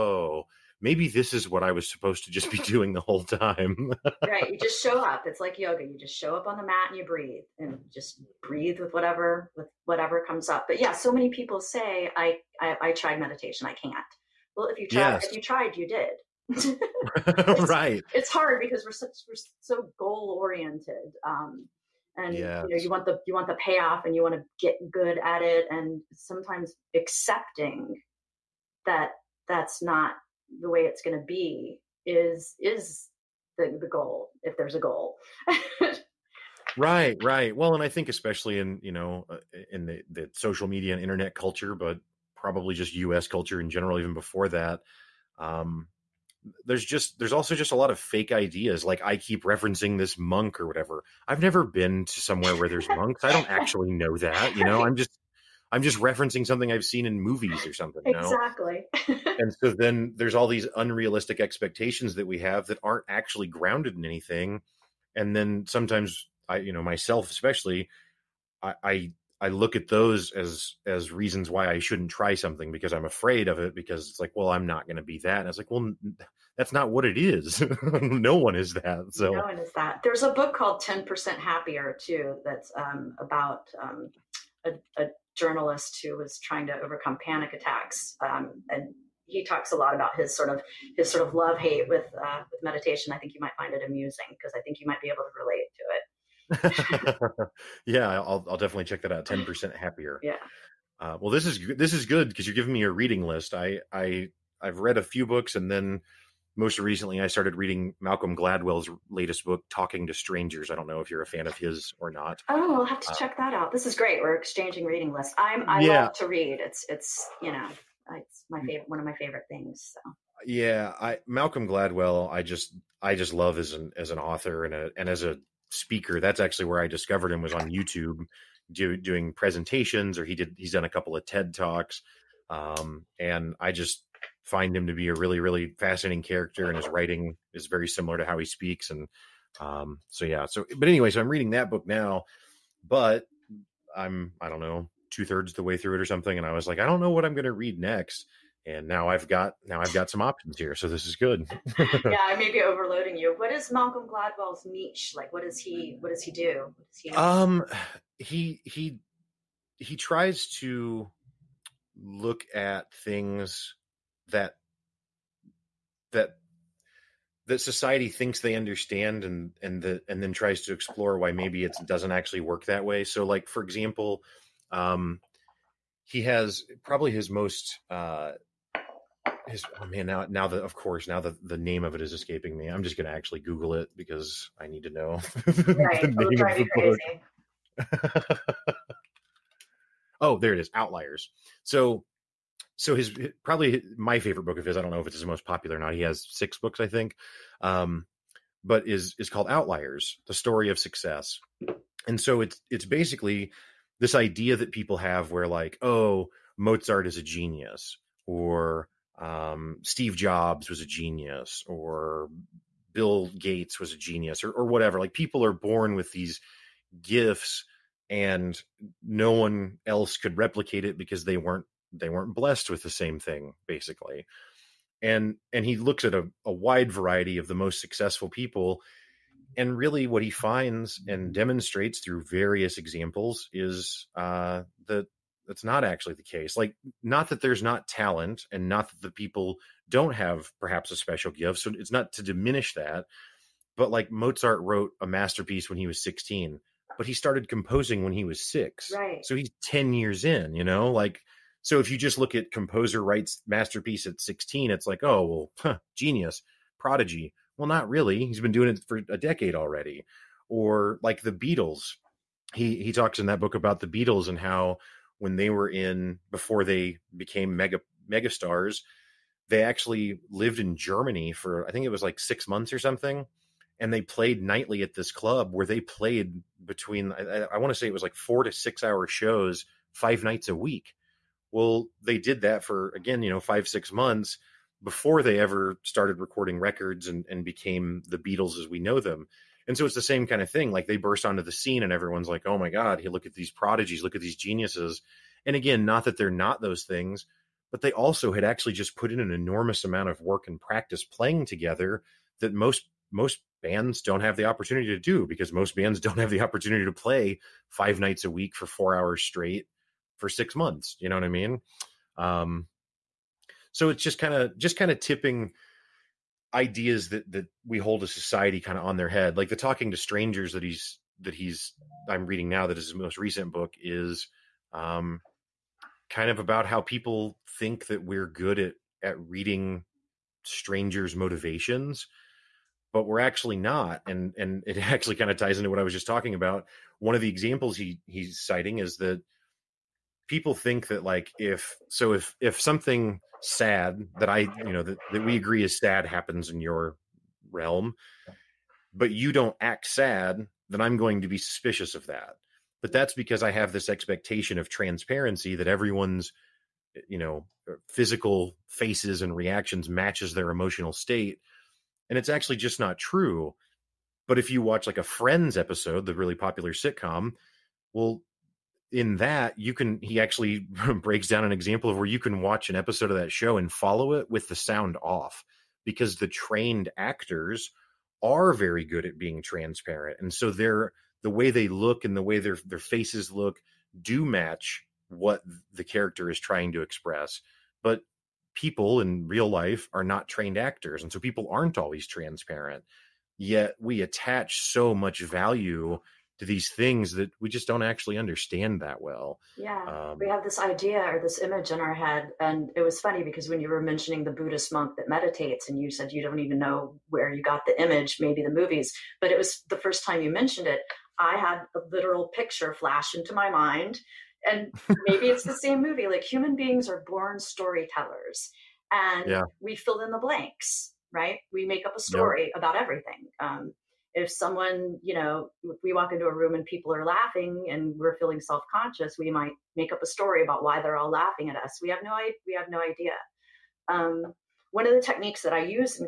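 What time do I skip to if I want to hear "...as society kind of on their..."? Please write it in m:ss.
5:18.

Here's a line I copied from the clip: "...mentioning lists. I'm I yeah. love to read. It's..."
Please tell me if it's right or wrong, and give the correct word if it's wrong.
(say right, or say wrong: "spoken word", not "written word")
wrong: "reading", not "mentioning".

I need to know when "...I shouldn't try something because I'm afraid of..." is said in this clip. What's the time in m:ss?
1:11.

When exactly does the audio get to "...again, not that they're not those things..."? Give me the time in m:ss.
4:55.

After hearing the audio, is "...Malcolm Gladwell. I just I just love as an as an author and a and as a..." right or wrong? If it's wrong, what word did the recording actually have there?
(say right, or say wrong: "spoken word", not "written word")
right.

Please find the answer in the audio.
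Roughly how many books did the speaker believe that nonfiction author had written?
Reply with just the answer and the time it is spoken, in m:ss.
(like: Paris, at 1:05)
6, at 3:16.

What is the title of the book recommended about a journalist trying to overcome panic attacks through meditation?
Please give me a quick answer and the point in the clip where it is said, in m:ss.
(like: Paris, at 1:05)
Ten Percent Happier, at 1:20.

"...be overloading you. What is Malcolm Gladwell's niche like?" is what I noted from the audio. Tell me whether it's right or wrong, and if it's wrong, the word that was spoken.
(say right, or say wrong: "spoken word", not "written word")
right.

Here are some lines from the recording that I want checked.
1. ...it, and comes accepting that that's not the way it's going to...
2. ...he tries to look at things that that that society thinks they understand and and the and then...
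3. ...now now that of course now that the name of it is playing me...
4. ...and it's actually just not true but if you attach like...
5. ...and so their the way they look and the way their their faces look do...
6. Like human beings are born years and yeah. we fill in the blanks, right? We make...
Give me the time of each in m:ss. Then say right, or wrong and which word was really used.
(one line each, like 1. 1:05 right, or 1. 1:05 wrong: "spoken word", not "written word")
1. 0:25 wrong: "sometimes", not "comes"
2. 2:39 right
3. 3:00 wrong: "escaping", not "playing"
4. 6:02 wrong: "watch", not "attach"
5. 6:20 right
6. 6:56 wrong: "storytellers", not "years".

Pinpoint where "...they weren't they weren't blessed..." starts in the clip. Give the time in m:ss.
3:41.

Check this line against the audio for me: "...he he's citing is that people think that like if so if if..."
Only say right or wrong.
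right.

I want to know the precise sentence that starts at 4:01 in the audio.
So it's not to diminish that.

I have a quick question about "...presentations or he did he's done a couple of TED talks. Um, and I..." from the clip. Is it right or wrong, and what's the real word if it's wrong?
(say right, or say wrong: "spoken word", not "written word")
right.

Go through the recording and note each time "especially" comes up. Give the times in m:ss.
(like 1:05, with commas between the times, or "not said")
0:38, 1:07.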